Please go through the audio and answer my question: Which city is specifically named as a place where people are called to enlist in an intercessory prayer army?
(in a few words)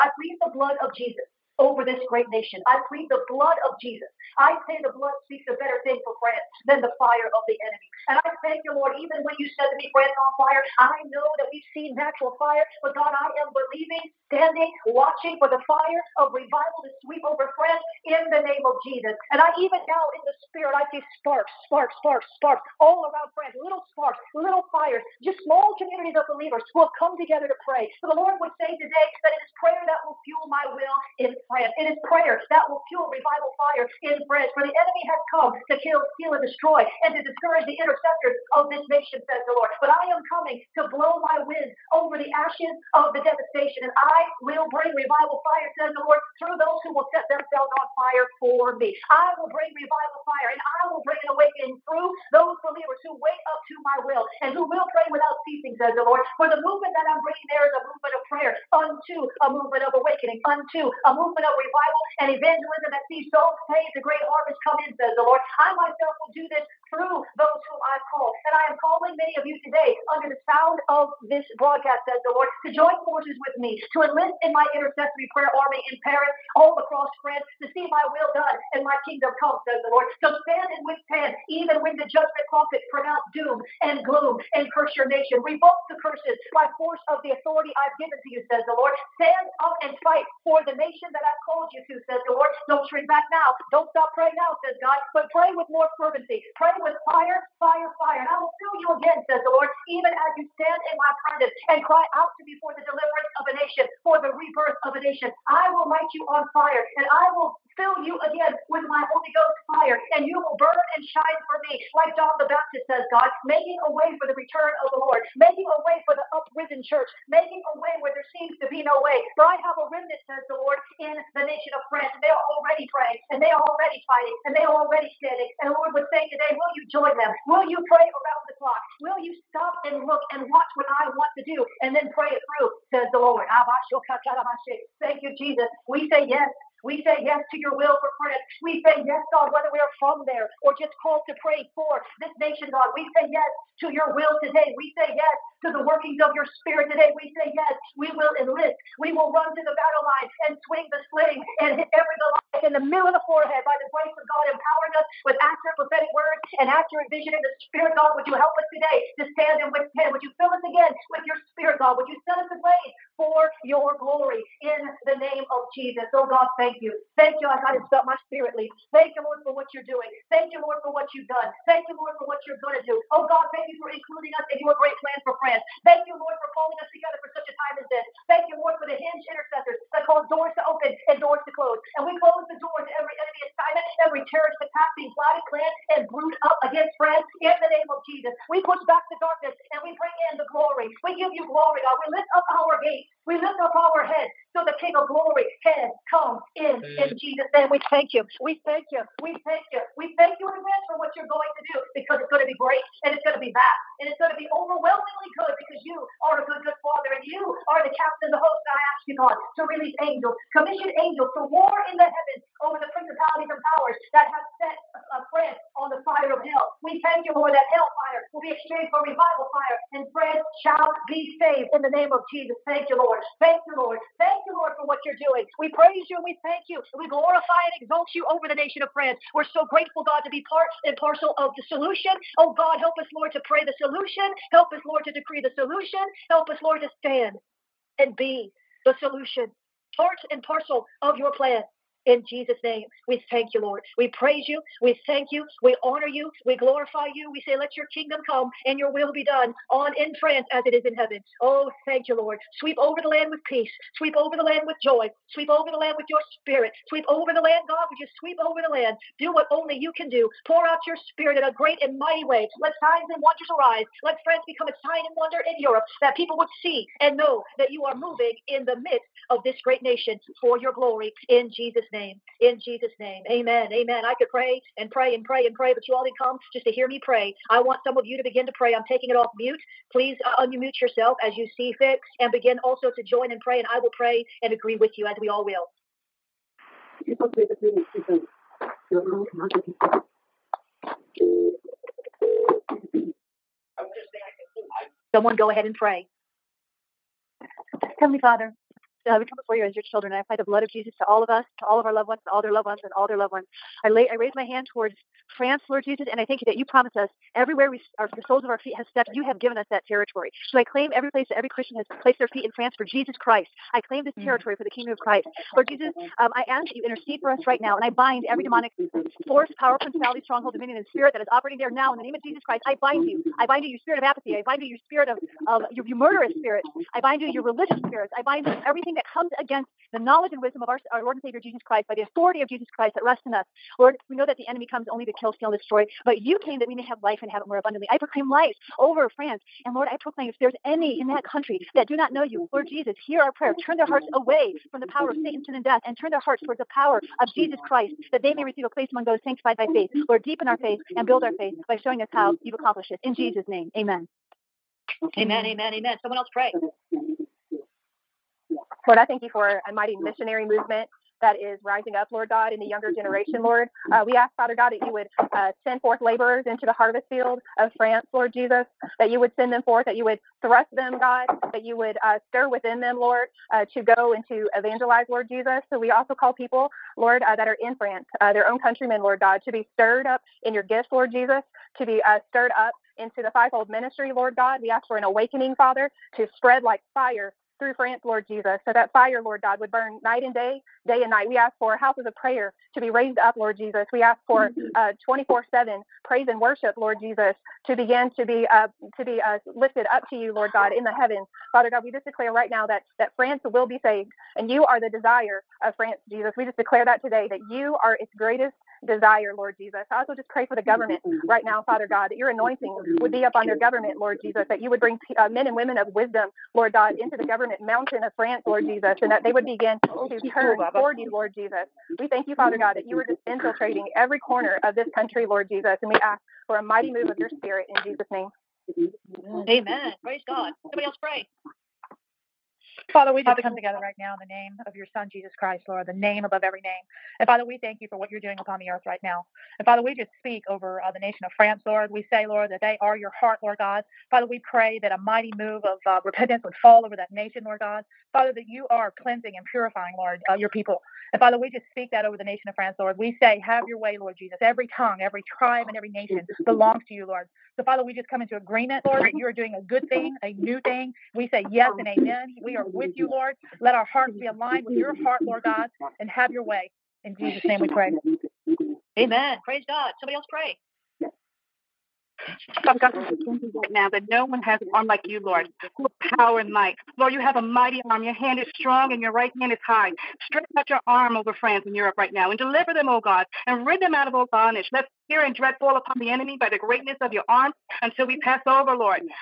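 Paris.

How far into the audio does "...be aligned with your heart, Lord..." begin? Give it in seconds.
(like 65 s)
464 s.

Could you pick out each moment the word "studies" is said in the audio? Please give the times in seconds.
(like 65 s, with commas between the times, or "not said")
not said.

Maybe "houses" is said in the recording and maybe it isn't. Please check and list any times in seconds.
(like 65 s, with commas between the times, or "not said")
391 s.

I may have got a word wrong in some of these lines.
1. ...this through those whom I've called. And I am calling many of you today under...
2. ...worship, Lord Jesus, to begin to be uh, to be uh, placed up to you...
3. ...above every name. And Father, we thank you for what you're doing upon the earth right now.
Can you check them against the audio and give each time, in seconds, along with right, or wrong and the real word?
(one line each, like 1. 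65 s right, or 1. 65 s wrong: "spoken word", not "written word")
1. 66 s right
2. 396 s wrong: "lifted", not "placed"
3. 436 s right.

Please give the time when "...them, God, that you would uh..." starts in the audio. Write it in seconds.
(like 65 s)
370 s.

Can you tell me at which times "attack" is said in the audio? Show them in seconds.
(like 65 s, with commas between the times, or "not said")
184 s.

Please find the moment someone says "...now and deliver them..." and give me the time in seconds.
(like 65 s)
482 s.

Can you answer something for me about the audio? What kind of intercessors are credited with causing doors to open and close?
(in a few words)
Hinge intercessors.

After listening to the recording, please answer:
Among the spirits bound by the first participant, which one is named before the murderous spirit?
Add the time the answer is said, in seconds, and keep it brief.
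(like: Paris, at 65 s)
Spirit of apathy, at 323 s.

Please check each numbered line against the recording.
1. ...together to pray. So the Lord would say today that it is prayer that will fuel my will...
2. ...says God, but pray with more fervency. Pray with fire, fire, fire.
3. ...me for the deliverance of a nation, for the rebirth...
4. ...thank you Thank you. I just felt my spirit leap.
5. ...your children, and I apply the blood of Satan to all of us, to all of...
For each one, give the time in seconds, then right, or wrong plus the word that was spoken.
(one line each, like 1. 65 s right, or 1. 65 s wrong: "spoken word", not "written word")
1. 27 s right
2. 94 s right
3. 102 s right
4. 166 s right
5. 299 s wrong: "Jesus", not "Satan".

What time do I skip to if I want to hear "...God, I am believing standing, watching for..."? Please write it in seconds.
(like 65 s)
12 s.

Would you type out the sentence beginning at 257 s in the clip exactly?
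Would you sweep over the land?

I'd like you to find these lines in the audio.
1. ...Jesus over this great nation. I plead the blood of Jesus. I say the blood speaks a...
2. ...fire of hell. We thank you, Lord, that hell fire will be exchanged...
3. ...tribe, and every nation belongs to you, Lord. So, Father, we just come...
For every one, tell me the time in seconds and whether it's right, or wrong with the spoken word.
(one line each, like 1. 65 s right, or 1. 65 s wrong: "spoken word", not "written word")
1. 0 s right
2. 216 s right
3. 455 s right.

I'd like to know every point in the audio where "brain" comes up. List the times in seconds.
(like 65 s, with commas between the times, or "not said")
not said.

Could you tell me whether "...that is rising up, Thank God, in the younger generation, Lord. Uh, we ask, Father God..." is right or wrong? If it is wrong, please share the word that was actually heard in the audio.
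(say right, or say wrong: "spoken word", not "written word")
wrong: "Lord", not "Thank".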